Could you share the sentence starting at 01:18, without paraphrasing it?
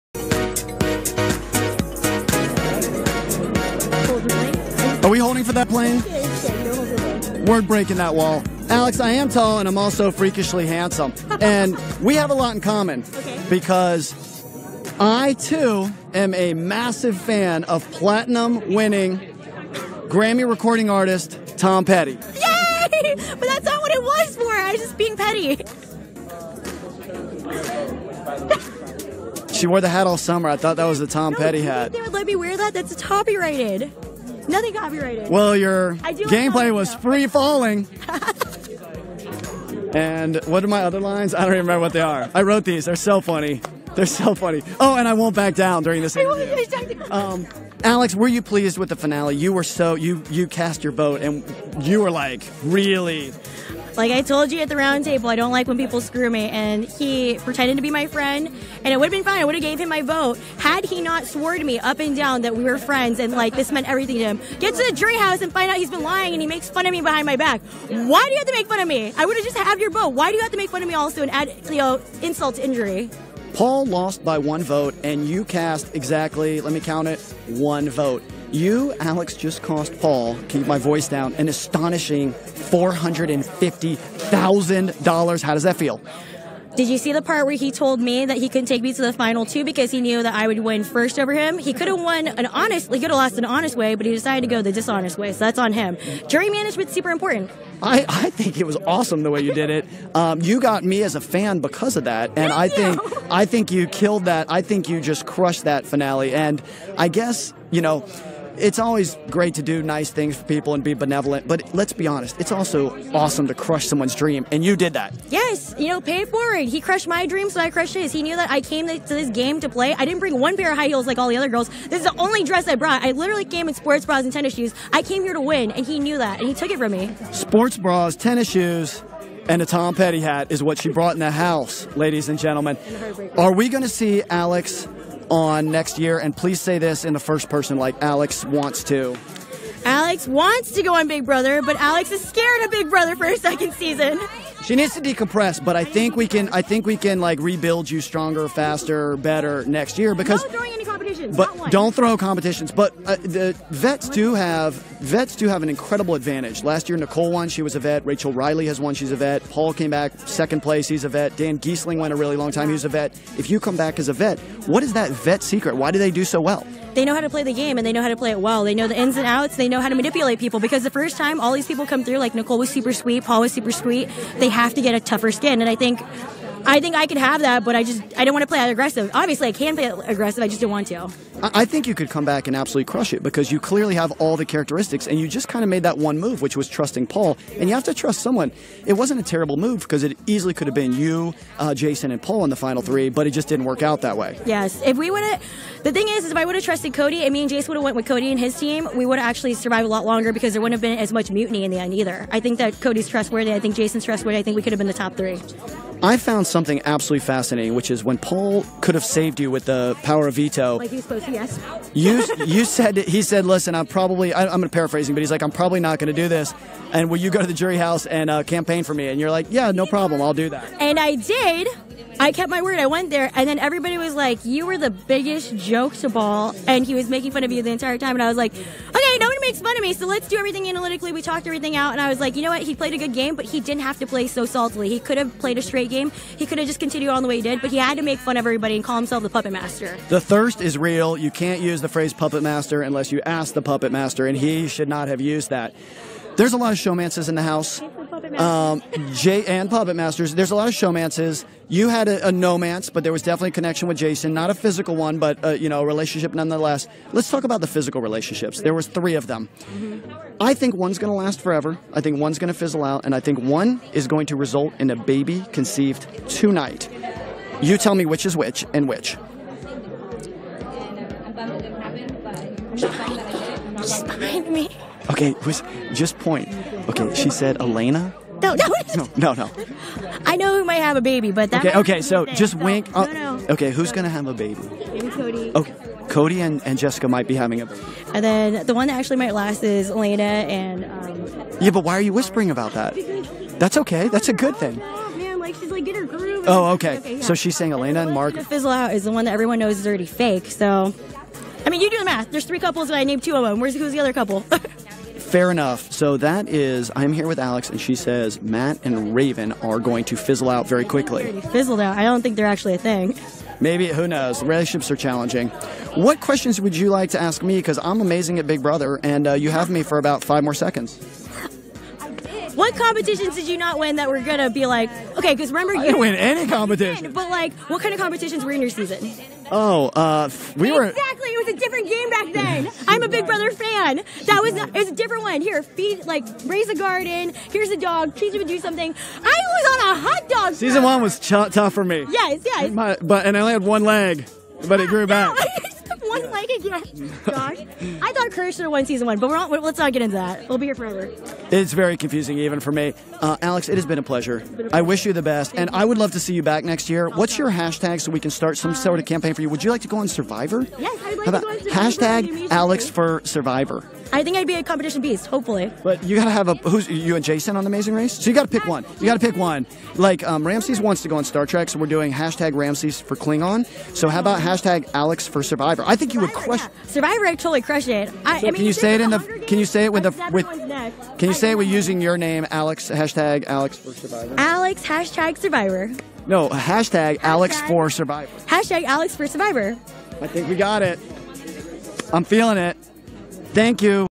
You, Alex, just cost Paul, keep my voice down, an astonishing $450,000.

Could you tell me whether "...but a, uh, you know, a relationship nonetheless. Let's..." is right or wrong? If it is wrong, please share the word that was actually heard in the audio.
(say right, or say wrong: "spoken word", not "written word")
right.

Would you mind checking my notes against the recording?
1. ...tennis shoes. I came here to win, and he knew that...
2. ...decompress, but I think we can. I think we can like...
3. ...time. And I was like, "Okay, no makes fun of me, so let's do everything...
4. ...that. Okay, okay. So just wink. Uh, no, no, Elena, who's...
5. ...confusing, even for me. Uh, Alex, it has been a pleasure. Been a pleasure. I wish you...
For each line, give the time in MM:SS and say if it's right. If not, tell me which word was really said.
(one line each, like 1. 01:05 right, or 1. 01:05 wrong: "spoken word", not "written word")
1. 02:04 right
2. 02:25 right
3. 03:47 right
4. 04:41 wrong: "Okay", not "Elena"
5. 05:51 right.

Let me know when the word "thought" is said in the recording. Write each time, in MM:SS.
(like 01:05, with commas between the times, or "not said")
00:30, 05:48.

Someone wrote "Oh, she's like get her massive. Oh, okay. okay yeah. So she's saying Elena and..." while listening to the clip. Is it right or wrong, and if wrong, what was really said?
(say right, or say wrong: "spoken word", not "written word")
wrong: "groove", not "massive".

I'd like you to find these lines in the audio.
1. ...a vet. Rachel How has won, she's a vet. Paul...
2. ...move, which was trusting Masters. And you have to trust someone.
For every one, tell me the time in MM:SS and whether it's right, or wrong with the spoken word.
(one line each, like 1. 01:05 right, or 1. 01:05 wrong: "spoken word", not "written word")
1. 02:37 wrong: "Reilly", not "How"
2. 03:06 wrong: "Paul", not "Masters".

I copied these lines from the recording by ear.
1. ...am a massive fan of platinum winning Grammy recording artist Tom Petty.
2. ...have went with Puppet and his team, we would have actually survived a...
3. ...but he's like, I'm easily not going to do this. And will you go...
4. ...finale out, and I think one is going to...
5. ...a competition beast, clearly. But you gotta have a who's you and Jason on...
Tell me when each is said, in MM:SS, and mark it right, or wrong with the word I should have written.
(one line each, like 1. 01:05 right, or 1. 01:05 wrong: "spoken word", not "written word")
1. 00:16 right
2. 03:17 wrong: "Cody", not "Puppet"
3. 03:35 wrong: "probably", not "easily"
4. 04:22 wrong: "fizzle", not "finale"
5. 06:04 wrong: "hopefully", not "clearly".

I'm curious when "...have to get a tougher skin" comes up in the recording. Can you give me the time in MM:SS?
02:54.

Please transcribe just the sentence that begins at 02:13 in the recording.
Are we going to see Alex on next year?